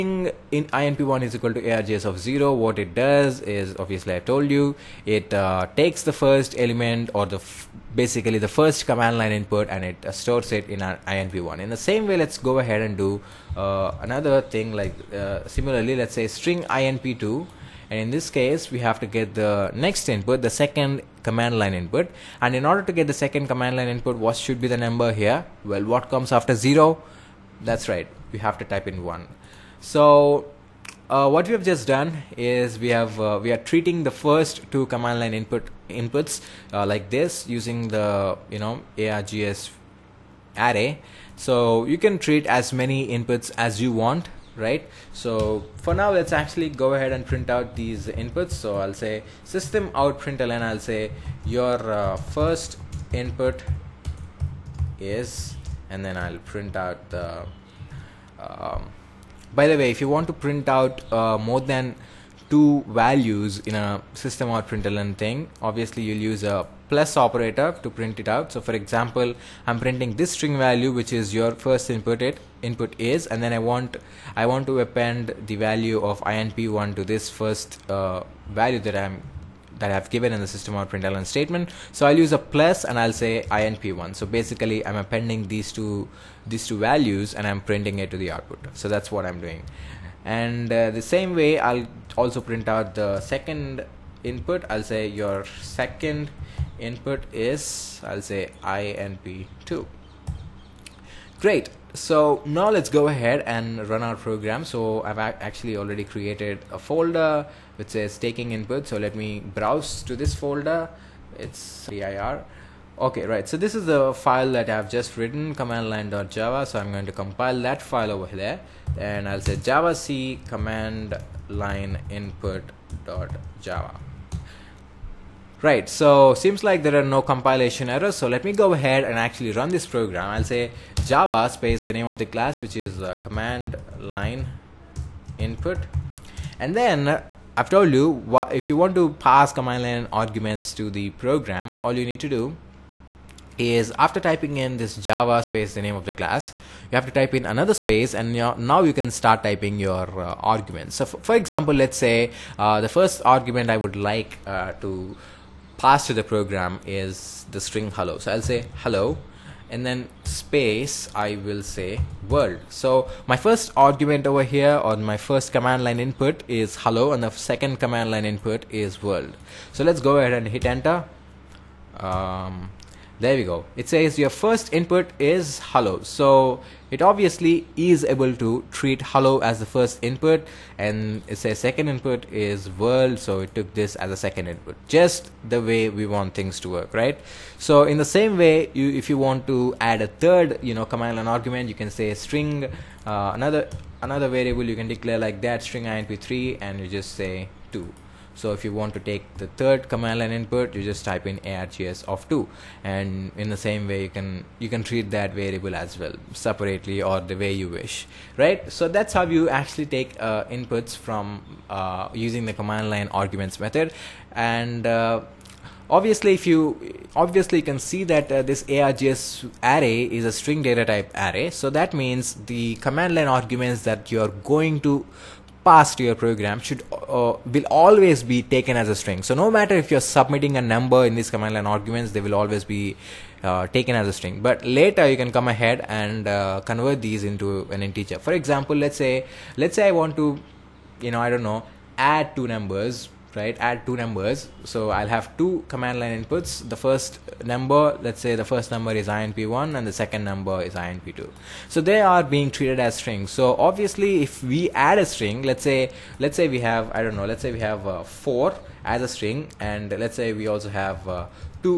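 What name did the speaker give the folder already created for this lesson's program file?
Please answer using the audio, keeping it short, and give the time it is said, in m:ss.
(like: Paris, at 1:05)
taking input, at 1:48.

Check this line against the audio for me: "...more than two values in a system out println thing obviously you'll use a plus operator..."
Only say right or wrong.
right.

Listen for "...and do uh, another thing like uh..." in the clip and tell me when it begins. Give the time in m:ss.
0:12.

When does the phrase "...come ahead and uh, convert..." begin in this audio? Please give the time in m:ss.
3:55.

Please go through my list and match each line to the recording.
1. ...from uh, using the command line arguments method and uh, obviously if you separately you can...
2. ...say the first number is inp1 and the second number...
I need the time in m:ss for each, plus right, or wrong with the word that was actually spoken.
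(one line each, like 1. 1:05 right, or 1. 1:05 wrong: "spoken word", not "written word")
1. 3:30 wrong: "obviously", not "separately"
2. 4:08 right.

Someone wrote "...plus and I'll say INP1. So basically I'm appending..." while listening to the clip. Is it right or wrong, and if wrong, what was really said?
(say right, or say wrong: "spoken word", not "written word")
right.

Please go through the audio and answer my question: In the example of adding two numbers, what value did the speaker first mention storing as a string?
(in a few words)
4.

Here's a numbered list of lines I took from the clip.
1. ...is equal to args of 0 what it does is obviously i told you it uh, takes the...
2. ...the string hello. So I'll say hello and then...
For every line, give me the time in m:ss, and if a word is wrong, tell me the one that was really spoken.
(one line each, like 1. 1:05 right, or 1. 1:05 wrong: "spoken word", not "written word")
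1. 0:01 right
2. 2:37 right.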